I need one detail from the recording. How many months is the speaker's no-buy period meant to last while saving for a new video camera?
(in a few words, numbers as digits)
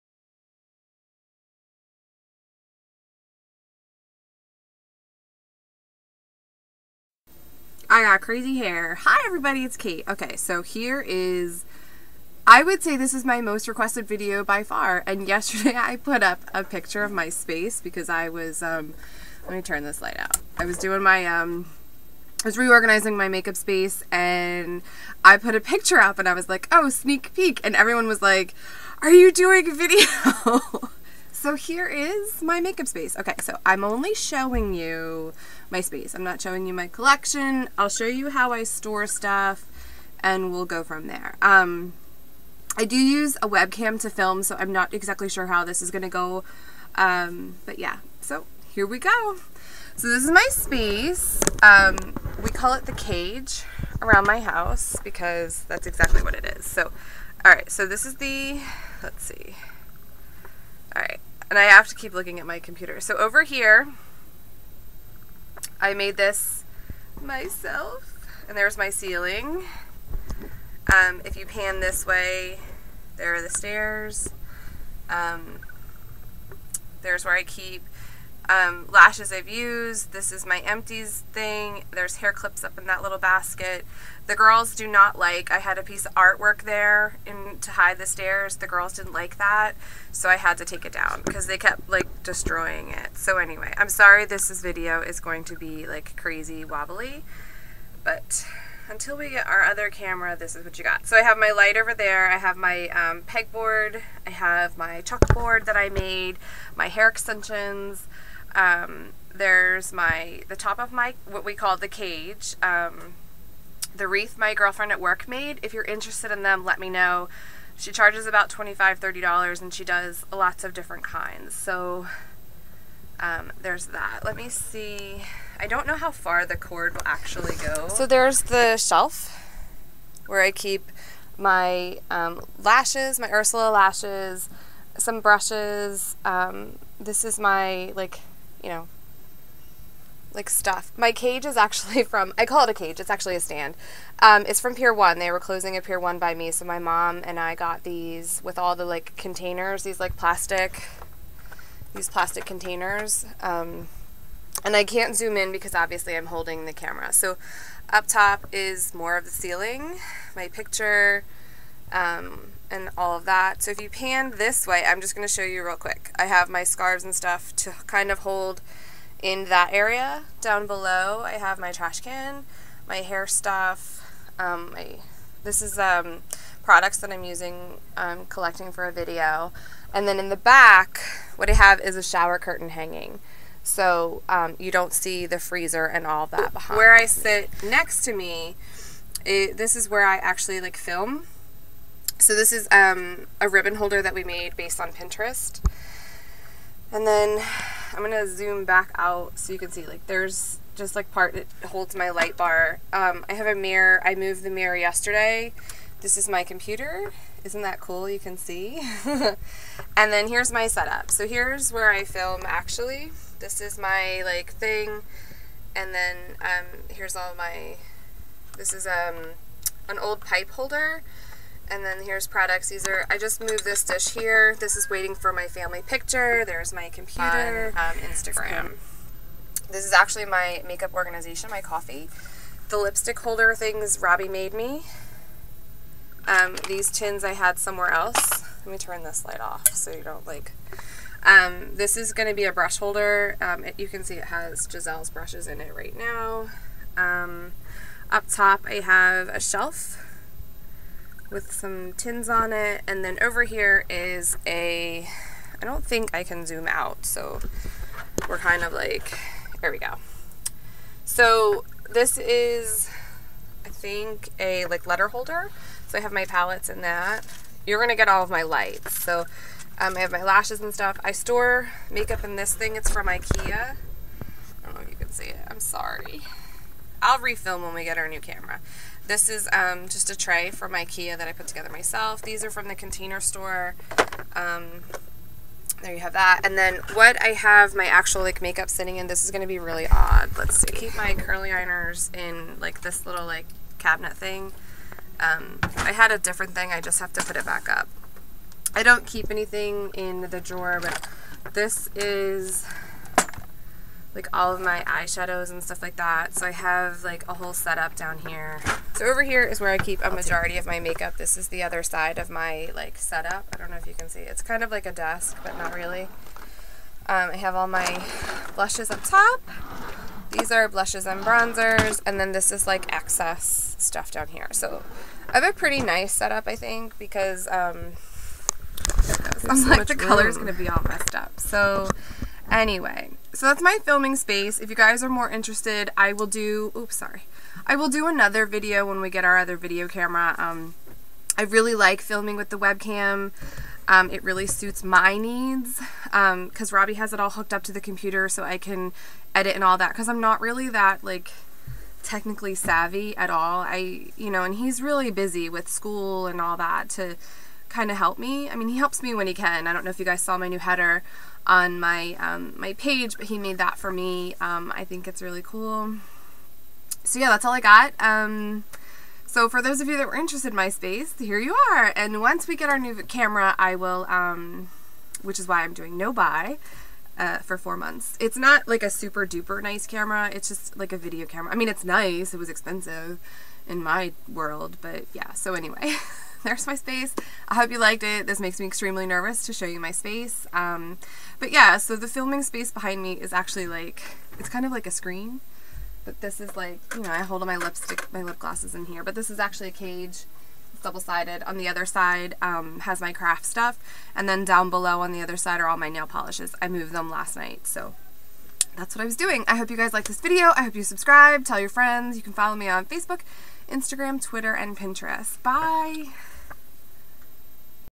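4.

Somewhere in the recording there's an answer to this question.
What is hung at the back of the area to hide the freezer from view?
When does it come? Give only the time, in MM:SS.
03:02.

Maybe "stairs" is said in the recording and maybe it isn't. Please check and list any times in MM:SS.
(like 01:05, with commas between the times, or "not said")
01:13, 01:28.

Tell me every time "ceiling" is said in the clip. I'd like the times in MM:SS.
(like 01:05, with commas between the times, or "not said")
01:08, 02:39.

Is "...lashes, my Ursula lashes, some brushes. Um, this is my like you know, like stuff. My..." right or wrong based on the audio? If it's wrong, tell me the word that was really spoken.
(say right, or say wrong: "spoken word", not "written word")
right.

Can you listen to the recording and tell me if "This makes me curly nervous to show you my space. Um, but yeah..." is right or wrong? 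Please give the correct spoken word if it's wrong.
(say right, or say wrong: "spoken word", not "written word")
wrong: "extremely", not "curly".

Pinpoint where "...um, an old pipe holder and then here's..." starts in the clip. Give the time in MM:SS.
03:38.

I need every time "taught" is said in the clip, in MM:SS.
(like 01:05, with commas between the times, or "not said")
not said.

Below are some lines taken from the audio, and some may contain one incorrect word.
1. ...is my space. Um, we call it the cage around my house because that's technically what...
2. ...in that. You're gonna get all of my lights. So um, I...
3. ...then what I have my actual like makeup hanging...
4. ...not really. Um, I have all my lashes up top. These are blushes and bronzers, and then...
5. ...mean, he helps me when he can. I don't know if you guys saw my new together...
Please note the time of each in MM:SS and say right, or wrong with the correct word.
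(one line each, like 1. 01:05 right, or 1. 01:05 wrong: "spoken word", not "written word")
1. 00:50 wrong: "exactly", not "technically"
2. 04:26 right
3. 04:46 wrong: "sitting", not "hanging"
4. 05:15 wrong: "blushes", not "lashes"
5. 05:58 wrong: "header", not "together".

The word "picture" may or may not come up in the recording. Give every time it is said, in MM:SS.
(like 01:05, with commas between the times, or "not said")
00:16, 00:25, 02:40, 03:45.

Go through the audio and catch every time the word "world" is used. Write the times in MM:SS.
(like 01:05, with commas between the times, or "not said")
06:24.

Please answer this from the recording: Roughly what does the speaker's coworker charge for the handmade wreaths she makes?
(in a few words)
$25 to $30.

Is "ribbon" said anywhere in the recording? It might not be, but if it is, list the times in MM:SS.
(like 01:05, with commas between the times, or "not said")
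03:13.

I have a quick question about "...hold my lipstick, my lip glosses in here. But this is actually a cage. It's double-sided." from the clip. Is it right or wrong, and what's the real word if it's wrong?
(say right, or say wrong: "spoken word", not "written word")
right.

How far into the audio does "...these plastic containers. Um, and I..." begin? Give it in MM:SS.
02:31.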